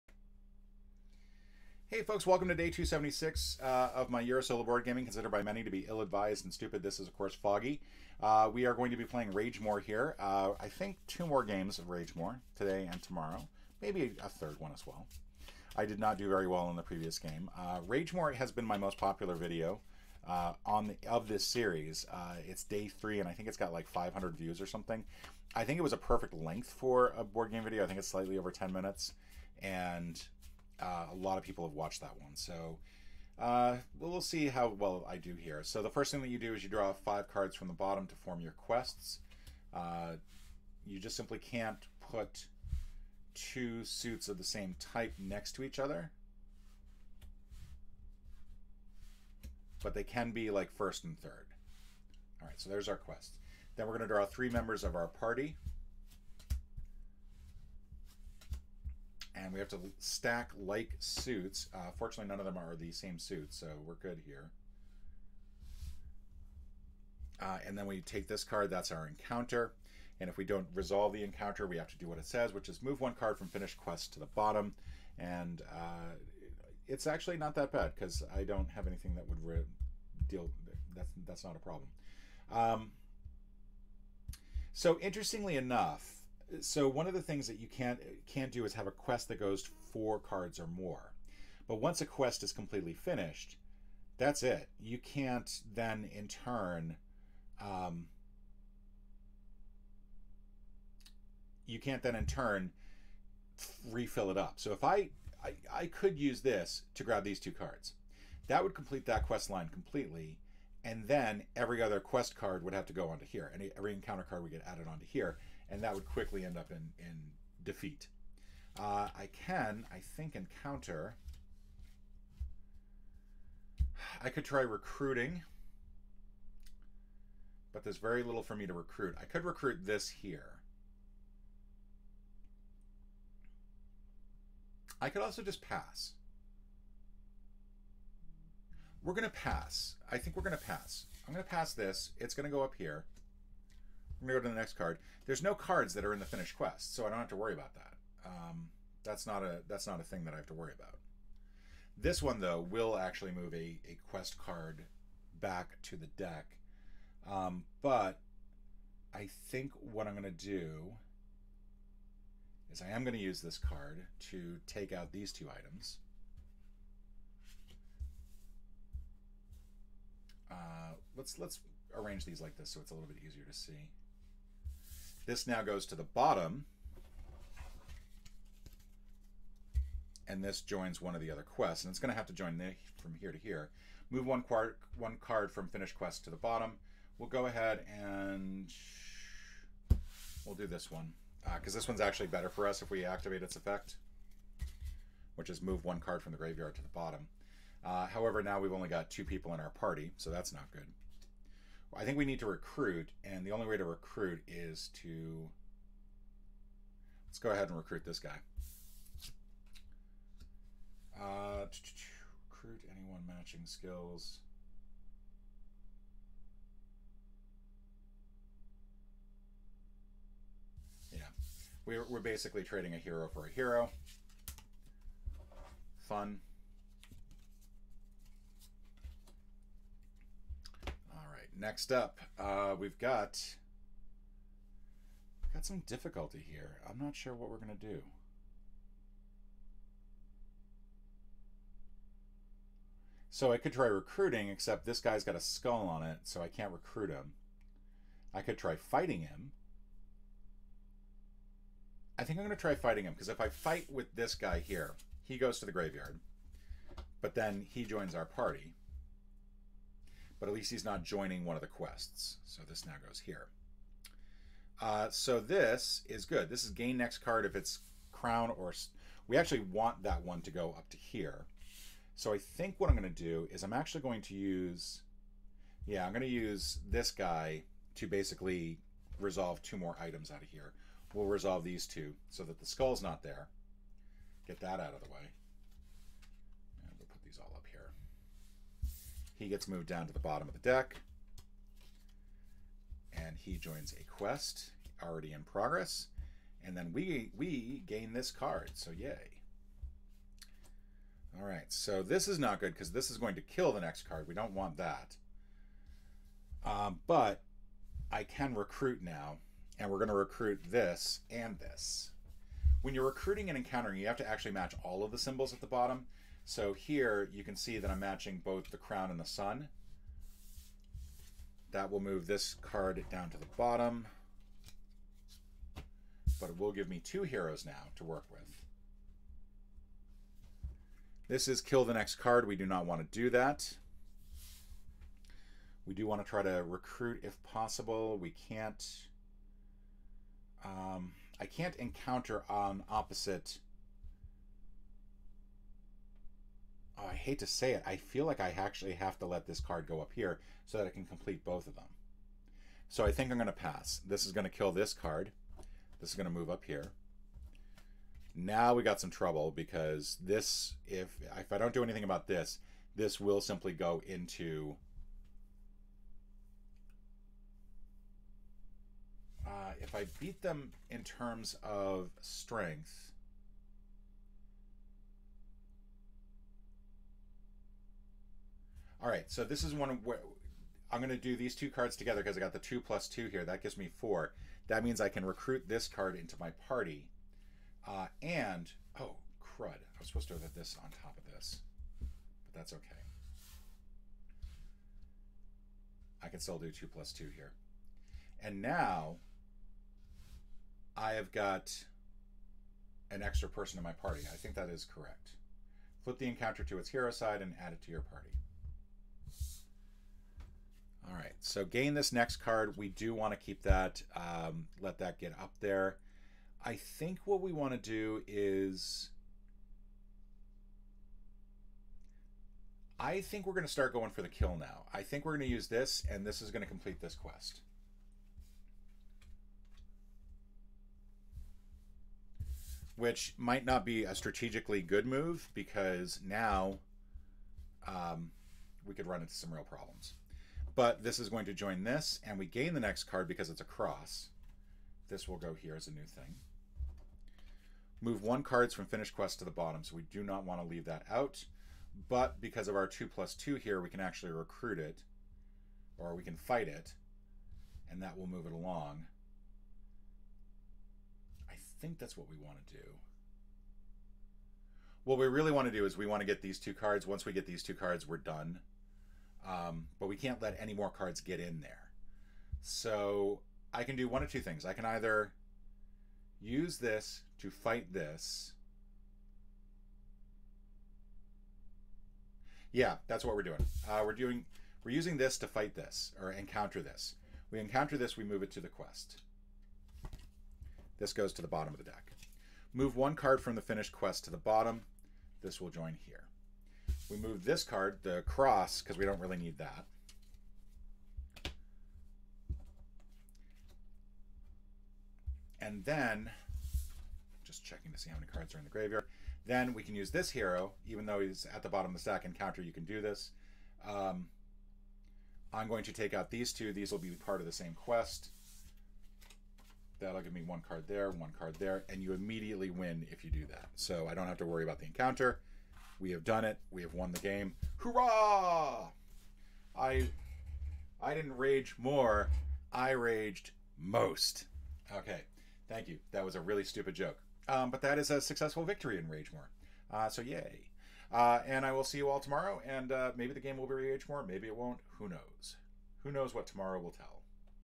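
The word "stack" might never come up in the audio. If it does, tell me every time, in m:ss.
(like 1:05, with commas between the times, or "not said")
0:59, 8:31.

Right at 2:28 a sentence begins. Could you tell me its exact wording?
Um, that's not a that's not a thing that I have to worry about.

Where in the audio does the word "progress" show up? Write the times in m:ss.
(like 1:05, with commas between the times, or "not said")
4:55.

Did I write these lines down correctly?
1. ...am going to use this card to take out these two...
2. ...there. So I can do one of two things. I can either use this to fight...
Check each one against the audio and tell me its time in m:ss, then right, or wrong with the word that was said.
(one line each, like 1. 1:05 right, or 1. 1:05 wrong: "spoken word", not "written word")
1. 2:42 right
2. 7:51 right.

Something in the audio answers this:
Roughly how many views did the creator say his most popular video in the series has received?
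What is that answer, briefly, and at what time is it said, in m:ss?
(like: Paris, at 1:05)
500, at 0:23.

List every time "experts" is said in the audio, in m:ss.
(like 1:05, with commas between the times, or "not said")
not said.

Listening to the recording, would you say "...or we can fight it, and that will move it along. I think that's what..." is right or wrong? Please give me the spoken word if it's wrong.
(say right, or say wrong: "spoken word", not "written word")
right.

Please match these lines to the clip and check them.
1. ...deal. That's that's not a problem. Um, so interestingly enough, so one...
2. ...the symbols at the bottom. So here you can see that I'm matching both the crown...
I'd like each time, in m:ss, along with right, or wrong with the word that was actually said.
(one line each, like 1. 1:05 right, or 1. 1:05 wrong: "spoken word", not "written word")
1. 1:20 right
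2. 5:15 right.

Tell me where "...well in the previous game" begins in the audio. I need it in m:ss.
0:16.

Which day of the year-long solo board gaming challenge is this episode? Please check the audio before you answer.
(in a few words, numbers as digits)
276.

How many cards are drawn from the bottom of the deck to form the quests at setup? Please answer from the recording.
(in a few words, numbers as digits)
5.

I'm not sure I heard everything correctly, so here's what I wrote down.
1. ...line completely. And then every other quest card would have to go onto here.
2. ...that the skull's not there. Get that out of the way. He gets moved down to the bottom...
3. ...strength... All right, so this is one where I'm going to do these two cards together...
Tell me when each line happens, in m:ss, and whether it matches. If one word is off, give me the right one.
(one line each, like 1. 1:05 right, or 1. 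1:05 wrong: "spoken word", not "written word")
1. 1:49 right
2. 4:42 right
3. 6:12 right.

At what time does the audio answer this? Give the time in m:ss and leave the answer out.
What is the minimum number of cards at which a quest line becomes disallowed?
1:29.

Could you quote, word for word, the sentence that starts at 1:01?
Uh, fortunately, none of them are the same suit, so we're good here.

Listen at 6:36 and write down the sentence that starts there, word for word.
I can still do two plus two here.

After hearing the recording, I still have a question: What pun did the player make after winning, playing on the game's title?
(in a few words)
I raged most.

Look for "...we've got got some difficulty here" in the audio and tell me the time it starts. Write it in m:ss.
3:52.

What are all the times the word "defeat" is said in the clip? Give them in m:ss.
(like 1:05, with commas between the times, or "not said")
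1:57.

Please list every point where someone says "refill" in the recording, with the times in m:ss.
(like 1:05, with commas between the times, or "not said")
1:43.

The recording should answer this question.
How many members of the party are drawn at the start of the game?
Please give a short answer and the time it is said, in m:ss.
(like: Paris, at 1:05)
3, at 0:54.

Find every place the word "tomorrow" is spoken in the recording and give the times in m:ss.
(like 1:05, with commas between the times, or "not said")
0:13, 9:02, 9:06.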